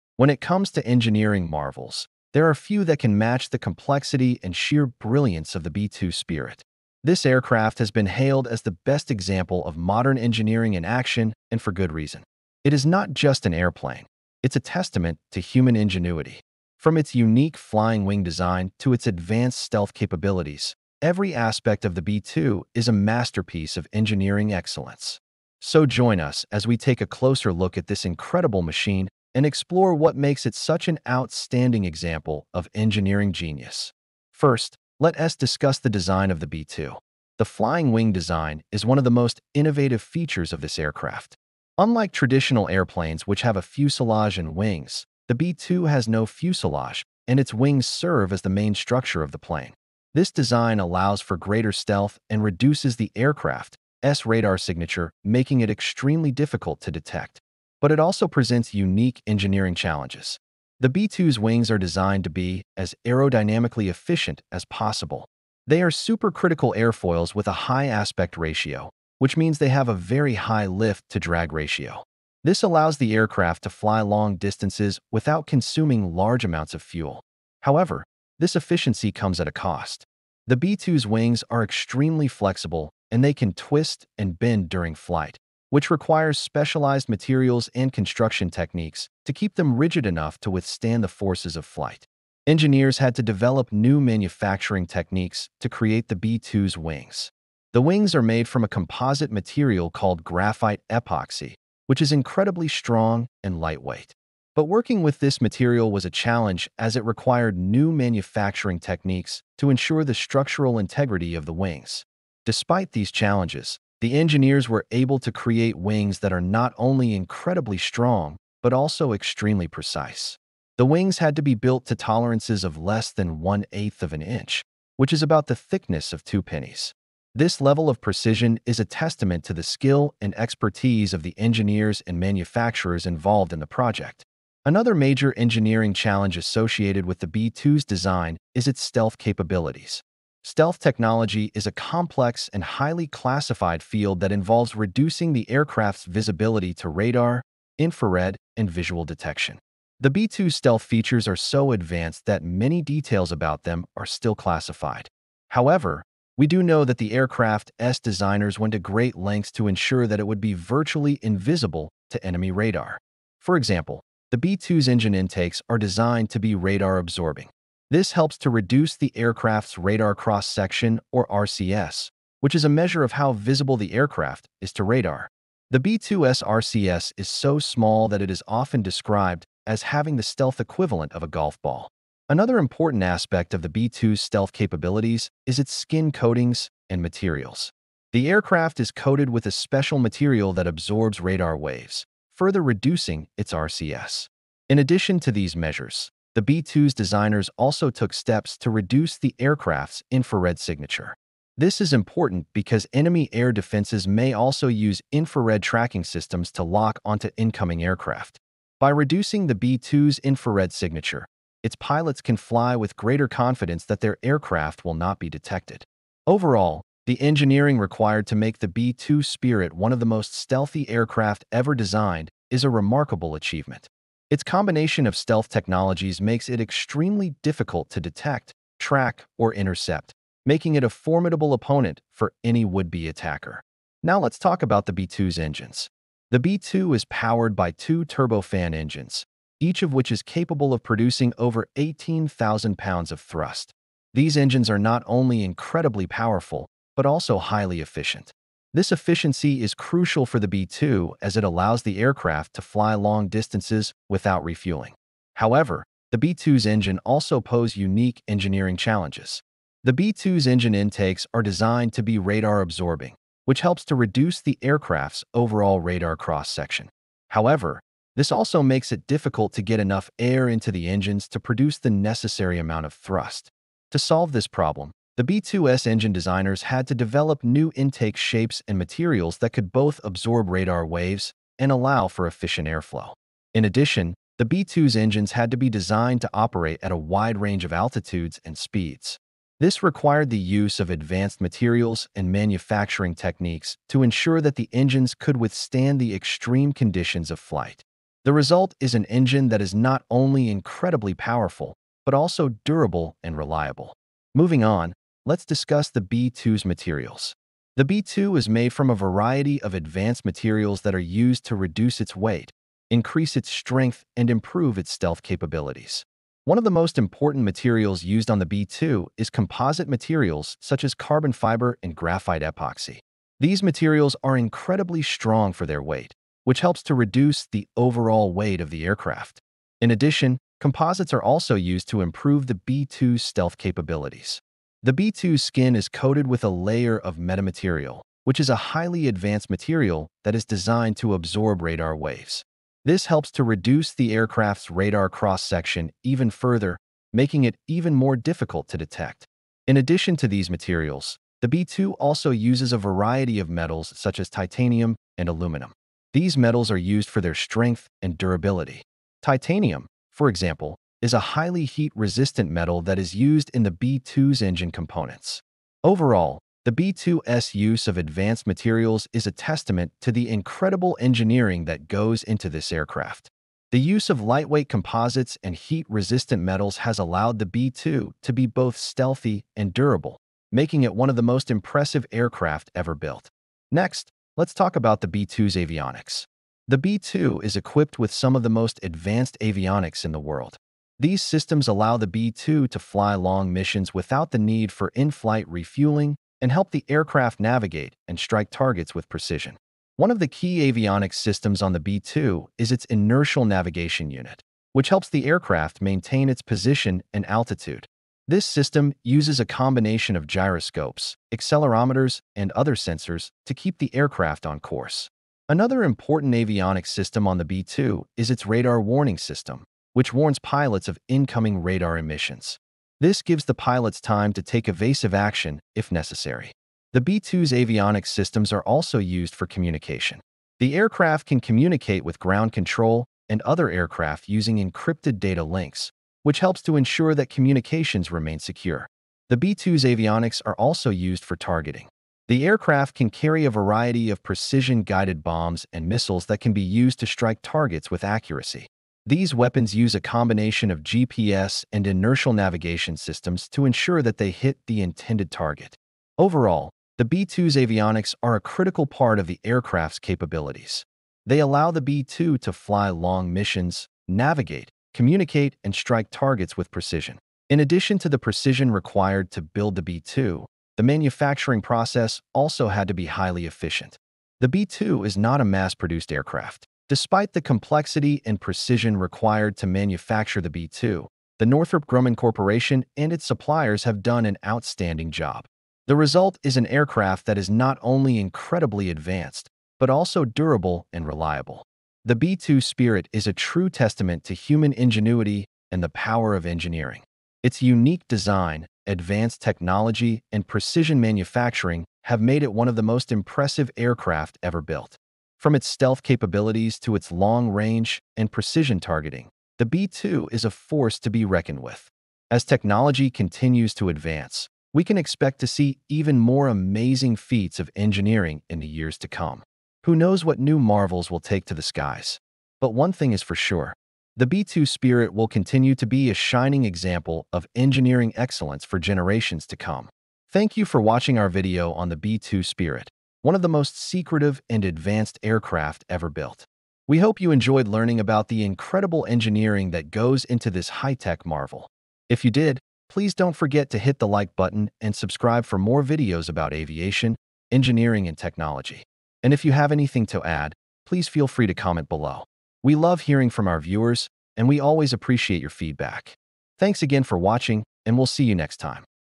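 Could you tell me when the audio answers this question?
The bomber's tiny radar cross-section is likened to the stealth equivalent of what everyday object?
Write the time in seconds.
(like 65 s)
181 s.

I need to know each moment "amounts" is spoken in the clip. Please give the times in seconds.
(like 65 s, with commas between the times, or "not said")
76 s, 272 s.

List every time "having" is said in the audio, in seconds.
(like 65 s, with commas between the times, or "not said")
179 s.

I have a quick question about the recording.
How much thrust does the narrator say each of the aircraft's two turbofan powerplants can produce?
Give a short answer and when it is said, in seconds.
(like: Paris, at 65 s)
over 18,000 pounds, at 241 s.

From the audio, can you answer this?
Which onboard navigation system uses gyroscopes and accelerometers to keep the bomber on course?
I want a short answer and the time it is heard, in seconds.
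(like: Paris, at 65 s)
inertial navigation unit, at 402 s.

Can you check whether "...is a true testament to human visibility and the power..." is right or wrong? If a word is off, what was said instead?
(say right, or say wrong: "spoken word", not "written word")
wrong: "ingenuity", not "visibility".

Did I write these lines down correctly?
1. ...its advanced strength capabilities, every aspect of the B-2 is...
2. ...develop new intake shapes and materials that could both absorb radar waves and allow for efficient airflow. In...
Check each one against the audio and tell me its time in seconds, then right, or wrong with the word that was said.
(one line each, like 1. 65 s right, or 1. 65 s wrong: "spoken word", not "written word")
1. 18 s wrong: "stealth", not "strength"
2. 276 s right.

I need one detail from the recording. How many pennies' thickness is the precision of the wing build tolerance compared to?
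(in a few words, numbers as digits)
2.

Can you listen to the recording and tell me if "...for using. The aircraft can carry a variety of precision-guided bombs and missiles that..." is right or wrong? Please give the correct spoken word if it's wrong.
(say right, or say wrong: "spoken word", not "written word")
wrong: "targeting", not "using".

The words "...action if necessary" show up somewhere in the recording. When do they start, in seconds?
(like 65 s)
425 s.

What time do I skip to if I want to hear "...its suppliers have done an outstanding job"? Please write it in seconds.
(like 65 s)
483 s.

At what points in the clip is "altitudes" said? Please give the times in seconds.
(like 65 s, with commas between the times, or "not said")
287 s, 407 s.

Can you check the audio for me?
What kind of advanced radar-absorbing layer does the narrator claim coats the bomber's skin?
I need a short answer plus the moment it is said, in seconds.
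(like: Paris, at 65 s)
metamaterial, at 337 s.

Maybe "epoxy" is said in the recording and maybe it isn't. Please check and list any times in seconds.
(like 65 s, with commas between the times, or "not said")
100 s, 322 s.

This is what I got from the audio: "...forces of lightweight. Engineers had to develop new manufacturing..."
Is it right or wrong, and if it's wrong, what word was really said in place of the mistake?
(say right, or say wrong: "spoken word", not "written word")
wrong: "flight", not "lightweight".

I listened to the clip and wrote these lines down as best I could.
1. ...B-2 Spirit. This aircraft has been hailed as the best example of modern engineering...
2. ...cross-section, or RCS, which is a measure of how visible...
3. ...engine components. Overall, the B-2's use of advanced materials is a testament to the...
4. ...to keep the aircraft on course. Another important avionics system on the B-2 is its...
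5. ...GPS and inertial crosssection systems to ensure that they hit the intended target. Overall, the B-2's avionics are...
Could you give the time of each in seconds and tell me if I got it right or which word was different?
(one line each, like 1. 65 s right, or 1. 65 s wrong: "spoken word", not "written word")
1. 5 s right
2. 170 s right
3. 364 s right
4. 413 s right
5. 450 s wrong: "navigation", not "crosssection".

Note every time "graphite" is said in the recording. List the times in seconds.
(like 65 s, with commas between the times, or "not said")
100 s, 321 s.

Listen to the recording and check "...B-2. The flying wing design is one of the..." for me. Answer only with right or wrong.
right.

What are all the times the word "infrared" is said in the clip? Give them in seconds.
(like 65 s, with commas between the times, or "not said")
147 s, 200 s, 205 s, 210 s.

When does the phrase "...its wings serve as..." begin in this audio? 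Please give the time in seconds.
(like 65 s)
47 s.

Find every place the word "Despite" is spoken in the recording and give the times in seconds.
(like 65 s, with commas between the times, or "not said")
112 s, 476 s.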